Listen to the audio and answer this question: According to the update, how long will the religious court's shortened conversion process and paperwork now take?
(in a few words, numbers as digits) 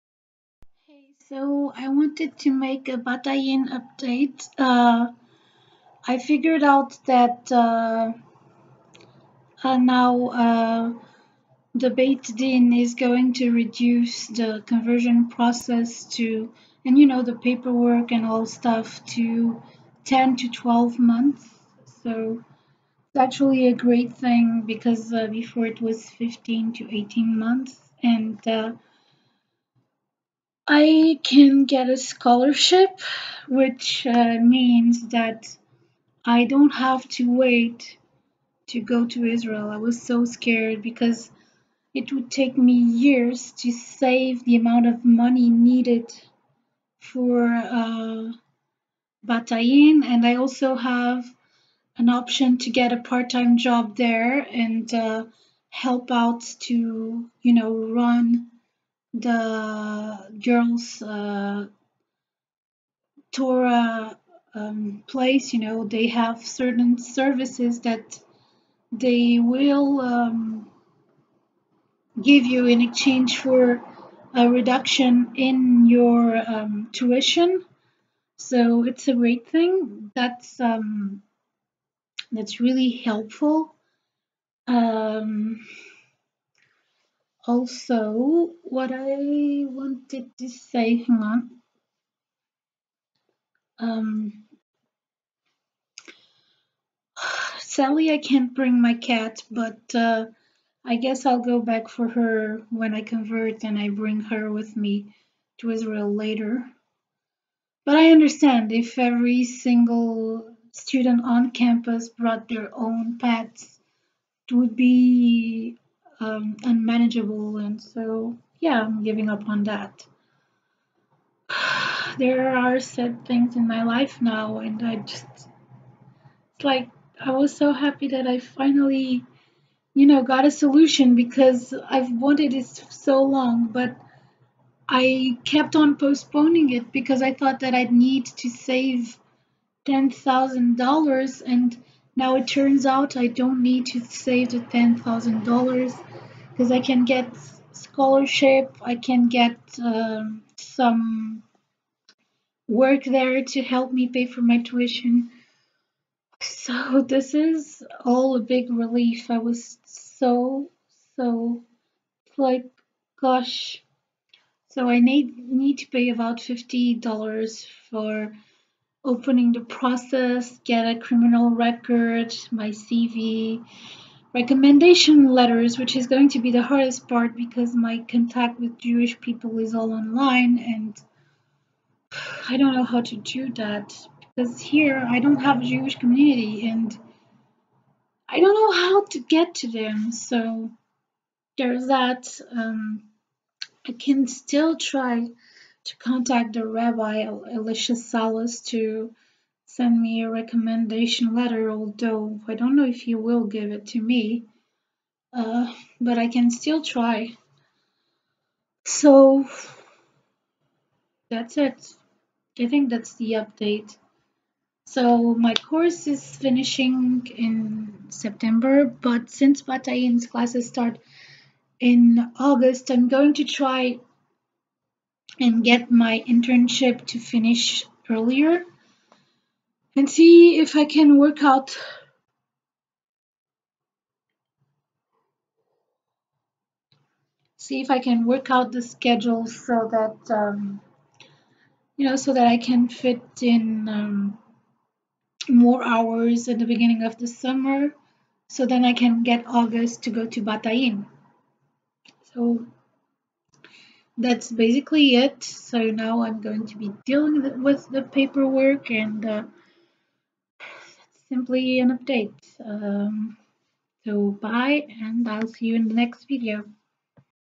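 10 to 12 months.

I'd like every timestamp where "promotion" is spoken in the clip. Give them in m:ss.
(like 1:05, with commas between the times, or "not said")
not said.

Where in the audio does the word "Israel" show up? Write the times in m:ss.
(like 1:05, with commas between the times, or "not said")
0:39, 1:45.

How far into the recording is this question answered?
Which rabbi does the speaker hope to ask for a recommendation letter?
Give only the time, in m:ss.
3:17.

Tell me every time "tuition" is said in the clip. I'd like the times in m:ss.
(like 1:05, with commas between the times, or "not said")
1:16, 2:34.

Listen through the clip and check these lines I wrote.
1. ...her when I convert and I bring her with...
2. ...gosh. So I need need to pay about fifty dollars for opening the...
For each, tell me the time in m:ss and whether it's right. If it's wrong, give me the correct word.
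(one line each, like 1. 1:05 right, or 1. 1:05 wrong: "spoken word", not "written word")
1. 1:42 right
2. 2:43 right.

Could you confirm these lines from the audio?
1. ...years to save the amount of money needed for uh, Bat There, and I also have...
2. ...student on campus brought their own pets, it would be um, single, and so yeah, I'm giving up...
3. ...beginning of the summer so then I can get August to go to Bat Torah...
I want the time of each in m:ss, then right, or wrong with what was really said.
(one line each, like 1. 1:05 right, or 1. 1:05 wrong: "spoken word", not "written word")
1. 0:43 wrong: "Ayin", not "There"
2. 1:50 wrong: "unmanageable", not "single"
3. 4:06 wrong: "Ayin", not "Torah".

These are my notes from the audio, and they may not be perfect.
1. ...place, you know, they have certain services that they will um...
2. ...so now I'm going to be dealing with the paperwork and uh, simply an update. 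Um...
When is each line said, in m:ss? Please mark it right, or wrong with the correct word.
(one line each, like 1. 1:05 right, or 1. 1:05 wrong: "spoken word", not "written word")
1. 1:05 right
2. 4:15 right.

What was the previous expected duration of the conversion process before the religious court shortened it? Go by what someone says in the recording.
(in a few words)
15 to 18 months.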